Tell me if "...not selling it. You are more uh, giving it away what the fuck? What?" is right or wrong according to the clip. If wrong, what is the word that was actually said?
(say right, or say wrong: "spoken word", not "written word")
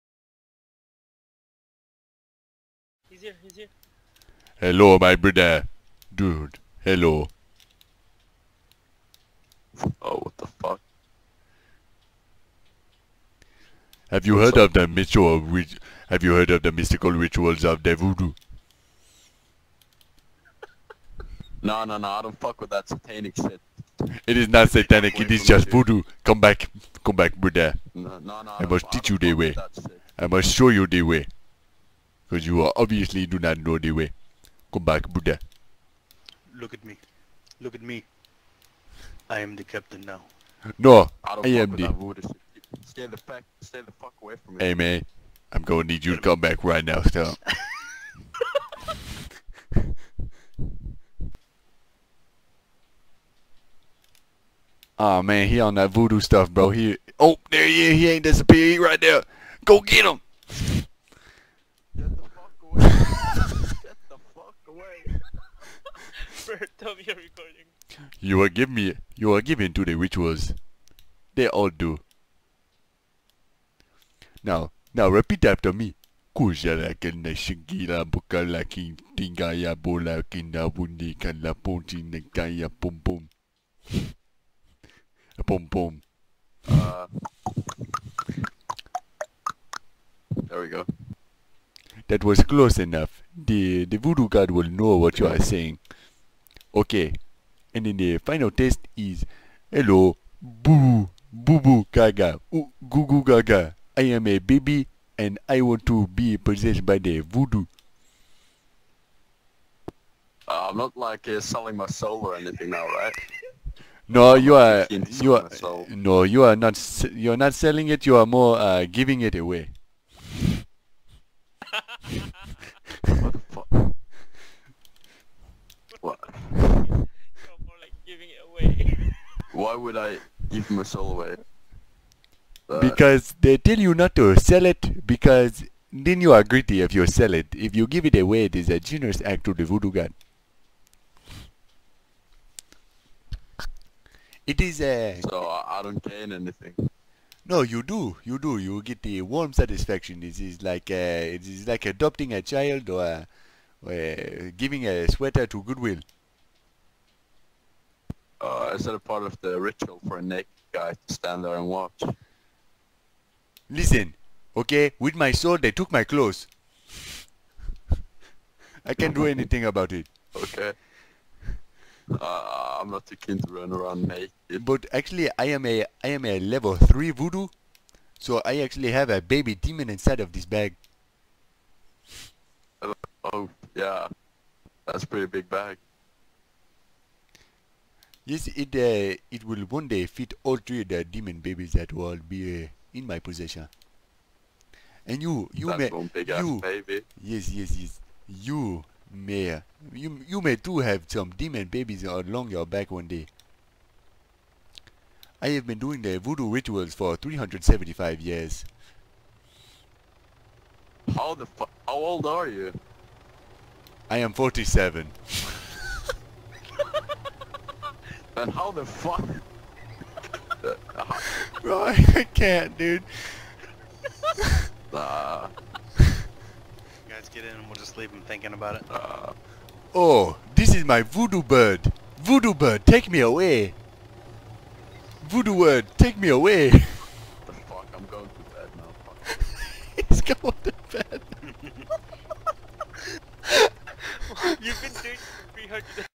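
right.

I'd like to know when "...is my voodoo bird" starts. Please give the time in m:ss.
3:50.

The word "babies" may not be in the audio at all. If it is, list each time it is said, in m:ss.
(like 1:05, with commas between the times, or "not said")
3:11, 3:21.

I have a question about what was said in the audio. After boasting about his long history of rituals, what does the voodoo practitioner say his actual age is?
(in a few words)
47.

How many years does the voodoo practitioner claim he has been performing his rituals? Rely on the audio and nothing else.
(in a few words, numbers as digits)
375.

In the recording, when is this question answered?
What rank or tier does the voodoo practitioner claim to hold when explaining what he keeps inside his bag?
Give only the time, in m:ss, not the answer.
2:56.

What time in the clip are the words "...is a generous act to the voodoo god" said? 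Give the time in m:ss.
2:18.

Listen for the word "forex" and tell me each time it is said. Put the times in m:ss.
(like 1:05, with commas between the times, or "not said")
not said.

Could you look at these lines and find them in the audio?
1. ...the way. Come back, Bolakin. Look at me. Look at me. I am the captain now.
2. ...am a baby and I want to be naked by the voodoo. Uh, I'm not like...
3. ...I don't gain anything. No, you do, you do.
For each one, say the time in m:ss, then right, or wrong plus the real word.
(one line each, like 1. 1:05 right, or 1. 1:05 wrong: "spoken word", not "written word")
1. 0:33 wrong: "Buddha", not "Bolakin"
2. 1:44 wrong: "possessed", not "naked"
3. 2:25 right.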